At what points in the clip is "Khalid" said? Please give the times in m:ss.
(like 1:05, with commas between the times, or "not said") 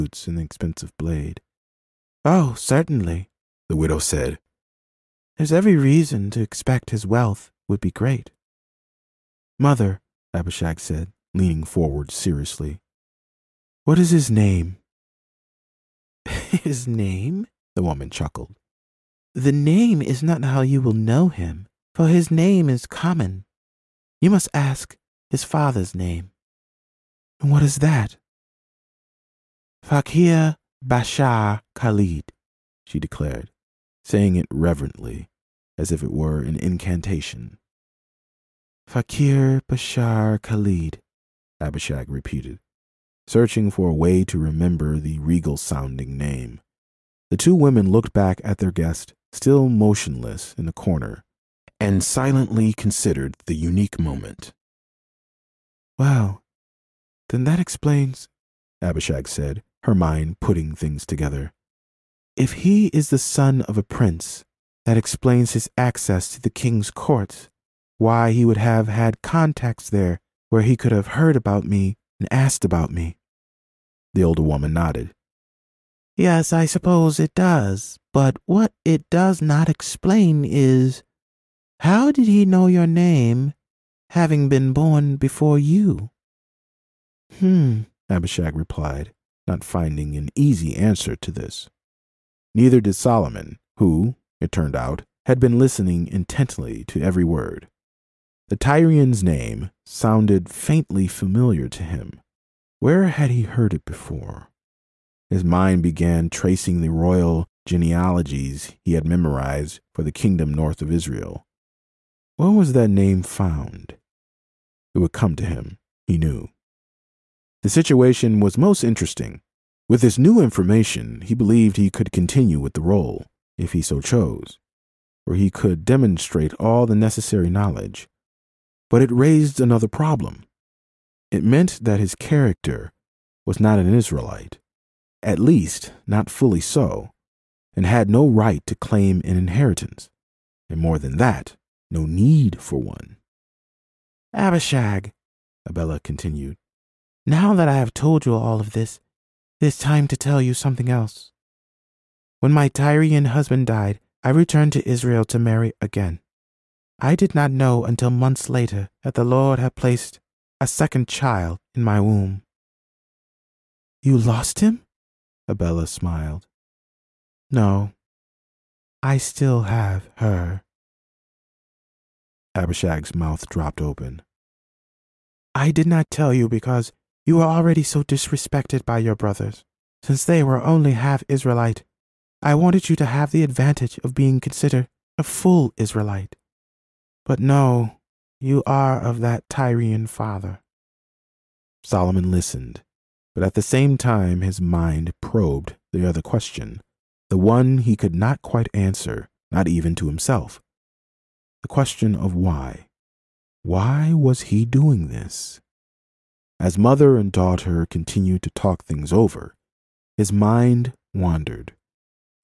0:31, 0:40.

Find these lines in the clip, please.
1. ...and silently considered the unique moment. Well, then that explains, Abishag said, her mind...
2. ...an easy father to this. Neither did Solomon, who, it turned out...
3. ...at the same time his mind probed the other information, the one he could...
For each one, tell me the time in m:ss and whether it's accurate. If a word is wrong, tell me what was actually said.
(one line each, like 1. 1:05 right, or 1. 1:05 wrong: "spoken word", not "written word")
1. 0:51 right
2. 1:30 wrong: "answer", not "father"
3. 3:13 wrong: "question", not "information".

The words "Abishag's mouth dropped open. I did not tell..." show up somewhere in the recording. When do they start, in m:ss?
2:52.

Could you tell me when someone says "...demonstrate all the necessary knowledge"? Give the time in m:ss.
2:05.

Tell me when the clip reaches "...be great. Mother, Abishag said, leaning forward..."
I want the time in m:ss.
0:07.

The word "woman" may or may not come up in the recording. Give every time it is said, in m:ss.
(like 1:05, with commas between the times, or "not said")
0:17, 1:14.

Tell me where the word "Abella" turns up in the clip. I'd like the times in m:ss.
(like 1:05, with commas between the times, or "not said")
2:25, 2:45.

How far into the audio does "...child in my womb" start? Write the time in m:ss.
2:41.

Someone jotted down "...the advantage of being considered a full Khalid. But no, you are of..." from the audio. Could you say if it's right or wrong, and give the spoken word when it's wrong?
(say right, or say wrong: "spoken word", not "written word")
wrong: "Israelite", not "Khalid".